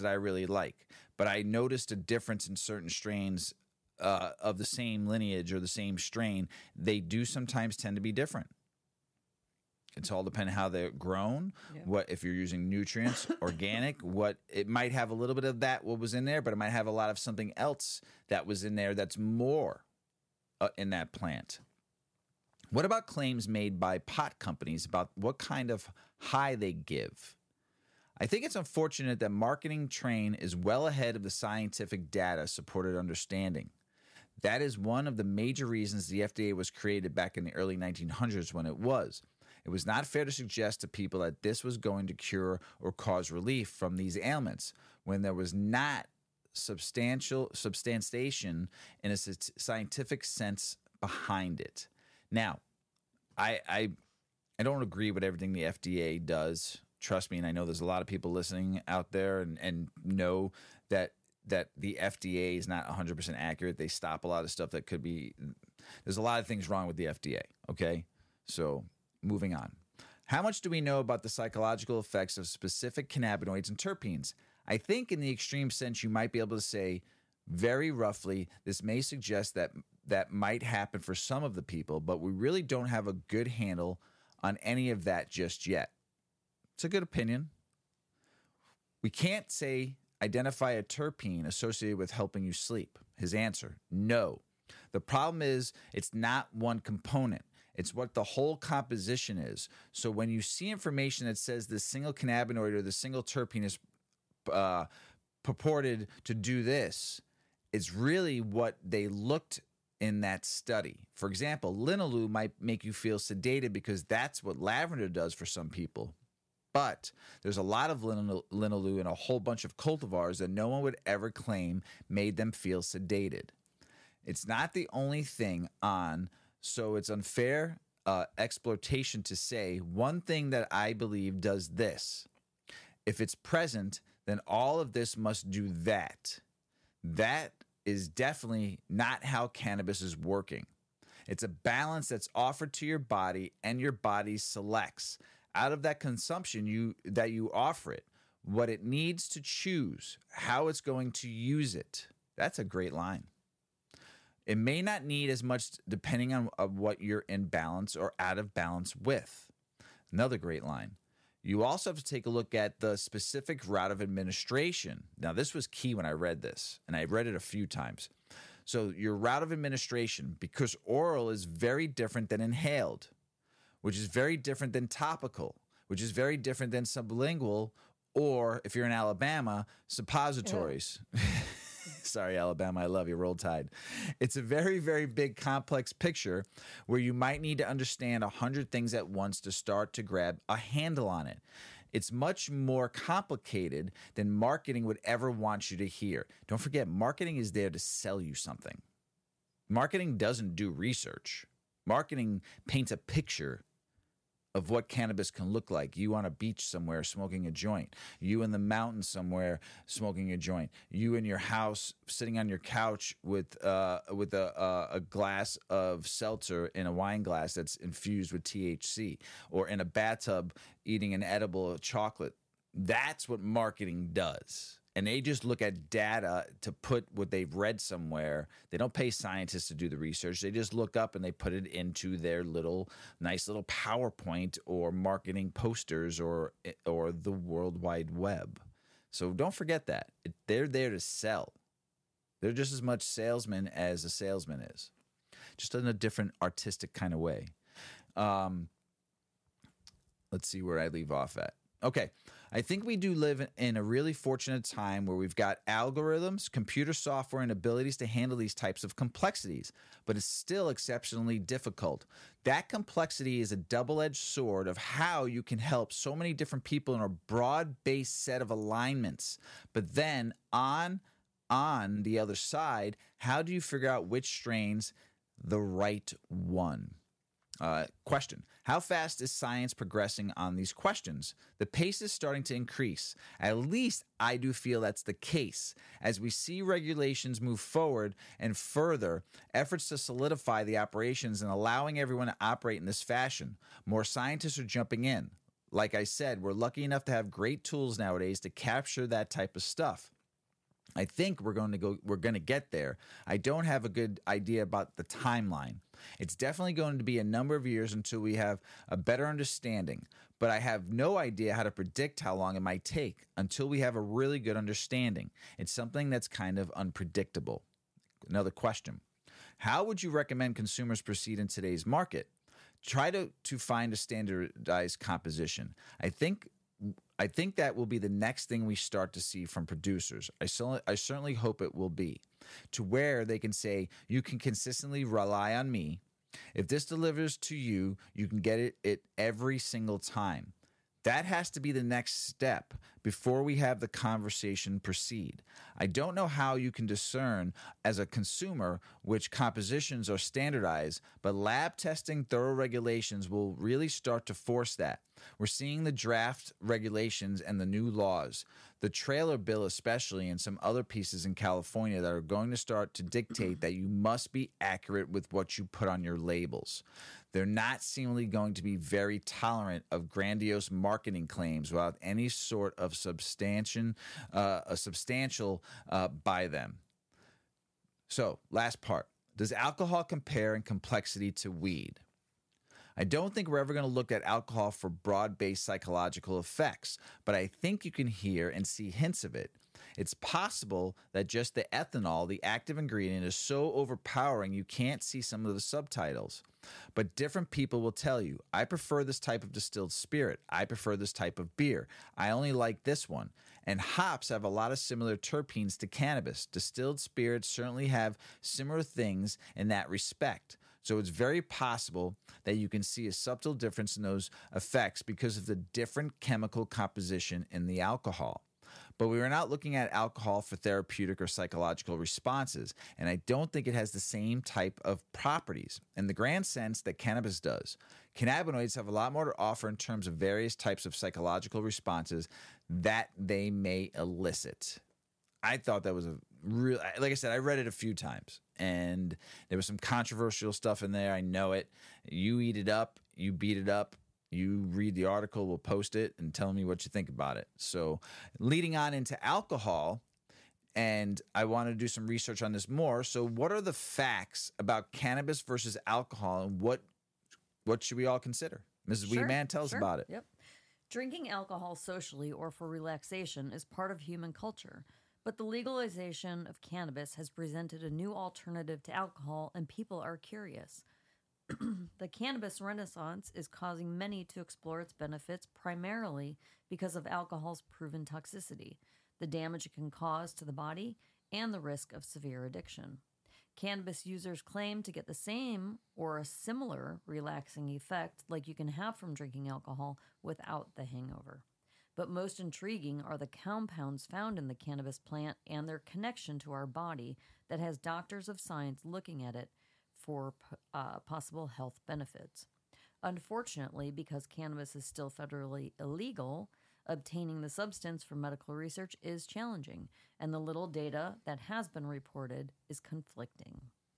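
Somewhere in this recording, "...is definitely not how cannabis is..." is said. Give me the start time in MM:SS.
02:17.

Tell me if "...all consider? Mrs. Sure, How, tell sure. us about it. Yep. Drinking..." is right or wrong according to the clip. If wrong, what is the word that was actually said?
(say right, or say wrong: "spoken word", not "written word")
wrong: "Weedman", not "How".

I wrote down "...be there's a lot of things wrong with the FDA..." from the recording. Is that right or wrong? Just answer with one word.
right.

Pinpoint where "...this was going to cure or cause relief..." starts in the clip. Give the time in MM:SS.
00:41.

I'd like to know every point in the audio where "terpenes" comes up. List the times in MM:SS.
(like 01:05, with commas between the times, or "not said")
01:13, 01:30, 01:43, 06:45.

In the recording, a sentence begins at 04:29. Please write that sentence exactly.
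But then on on the other side, how do you figure out which strains the right one?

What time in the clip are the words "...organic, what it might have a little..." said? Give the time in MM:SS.
00:13.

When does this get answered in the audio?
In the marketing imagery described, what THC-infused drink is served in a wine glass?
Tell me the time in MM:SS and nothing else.
03:36.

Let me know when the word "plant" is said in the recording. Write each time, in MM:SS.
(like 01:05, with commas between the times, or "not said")
00:21, 08:14.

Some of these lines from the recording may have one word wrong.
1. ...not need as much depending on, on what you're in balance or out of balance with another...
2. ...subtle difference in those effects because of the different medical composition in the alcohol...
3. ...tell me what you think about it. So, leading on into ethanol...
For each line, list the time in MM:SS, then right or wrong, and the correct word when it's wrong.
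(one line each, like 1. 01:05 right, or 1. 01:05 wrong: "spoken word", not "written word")
1. 02:34 right
2. 06:53 wrong: "chemical", not "medical"
3. 07:26 wrong: "alcohol", not "ethanol".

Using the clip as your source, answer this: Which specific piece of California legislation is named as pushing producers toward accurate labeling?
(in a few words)
the trailer bill.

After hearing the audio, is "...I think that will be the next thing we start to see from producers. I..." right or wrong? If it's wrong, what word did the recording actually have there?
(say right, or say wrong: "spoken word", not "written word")
right.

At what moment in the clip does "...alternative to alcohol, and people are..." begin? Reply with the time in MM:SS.
07:48.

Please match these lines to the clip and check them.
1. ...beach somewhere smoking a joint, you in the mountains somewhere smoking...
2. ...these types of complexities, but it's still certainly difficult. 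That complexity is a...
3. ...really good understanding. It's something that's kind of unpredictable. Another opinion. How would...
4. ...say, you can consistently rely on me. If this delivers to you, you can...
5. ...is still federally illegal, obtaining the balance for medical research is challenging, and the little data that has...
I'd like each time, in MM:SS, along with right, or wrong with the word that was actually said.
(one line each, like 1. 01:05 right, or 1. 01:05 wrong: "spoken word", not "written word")
1. 03:26 right
2. 04:18 wrong: "exceptionally", not "certainly"
3. 05:14 wrong: "question", not "opinion"
4. 05:33 right
5. 08:24 wrong: "substance", not "balance".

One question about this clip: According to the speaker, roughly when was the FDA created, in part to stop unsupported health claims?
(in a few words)
early 1900s.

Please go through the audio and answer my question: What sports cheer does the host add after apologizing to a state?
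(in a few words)
Roll Tide.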